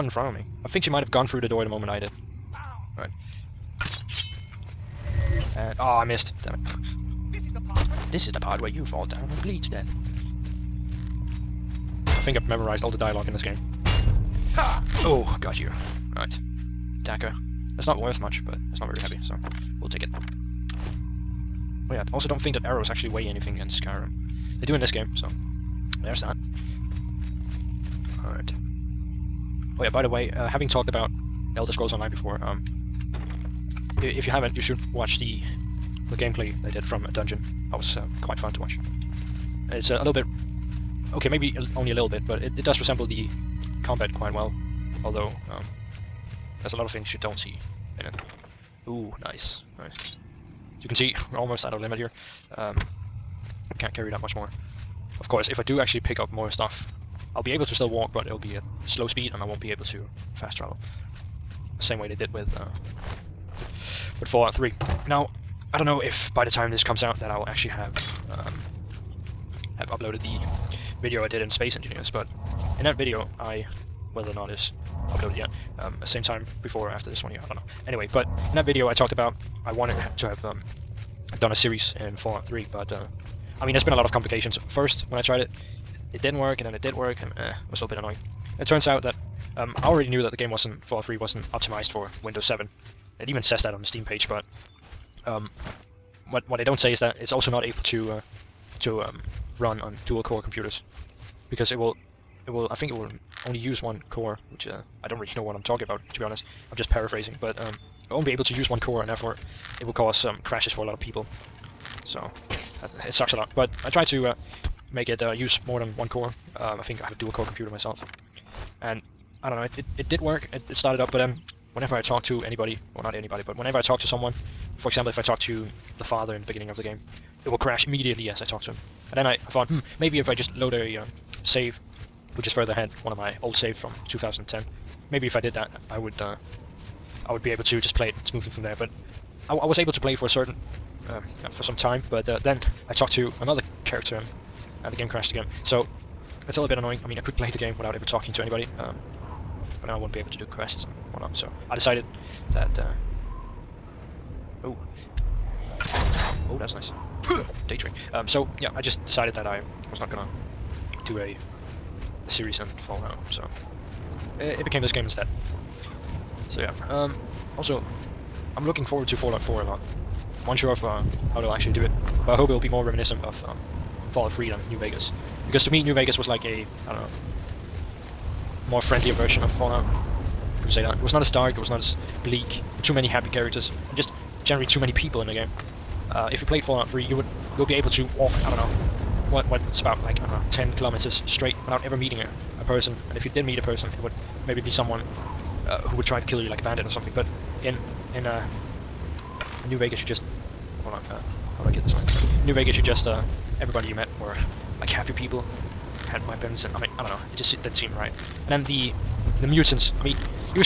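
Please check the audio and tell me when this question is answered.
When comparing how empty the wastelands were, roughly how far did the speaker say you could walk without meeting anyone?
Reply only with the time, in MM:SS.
03:10.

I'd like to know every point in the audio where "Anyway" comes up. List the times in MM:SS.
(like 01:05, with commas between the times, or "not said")
01:17.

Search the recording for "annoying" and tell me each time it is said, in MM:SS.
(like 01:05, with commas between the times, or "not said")
01:27, 02:26.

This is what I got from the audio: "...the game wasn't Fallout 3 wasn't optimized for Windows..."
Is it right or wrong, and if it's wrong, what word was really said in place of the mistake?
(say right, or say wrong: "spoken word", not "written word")
right.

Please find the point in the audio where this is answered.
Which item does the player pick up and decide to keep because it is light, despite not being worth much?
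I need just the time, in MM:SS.
00:17.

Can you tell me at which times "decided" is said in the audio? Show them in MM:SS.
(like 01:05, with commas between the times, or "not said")
02:31, 02:39.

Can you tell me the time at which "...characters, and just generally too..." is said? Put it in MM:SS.
03:03.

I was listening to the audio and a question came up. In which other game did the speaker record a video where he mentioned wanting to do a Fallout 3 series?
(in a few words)
Space Engineers.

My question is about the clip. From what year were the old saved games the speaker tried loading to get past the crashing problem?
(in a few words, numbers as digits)
2010.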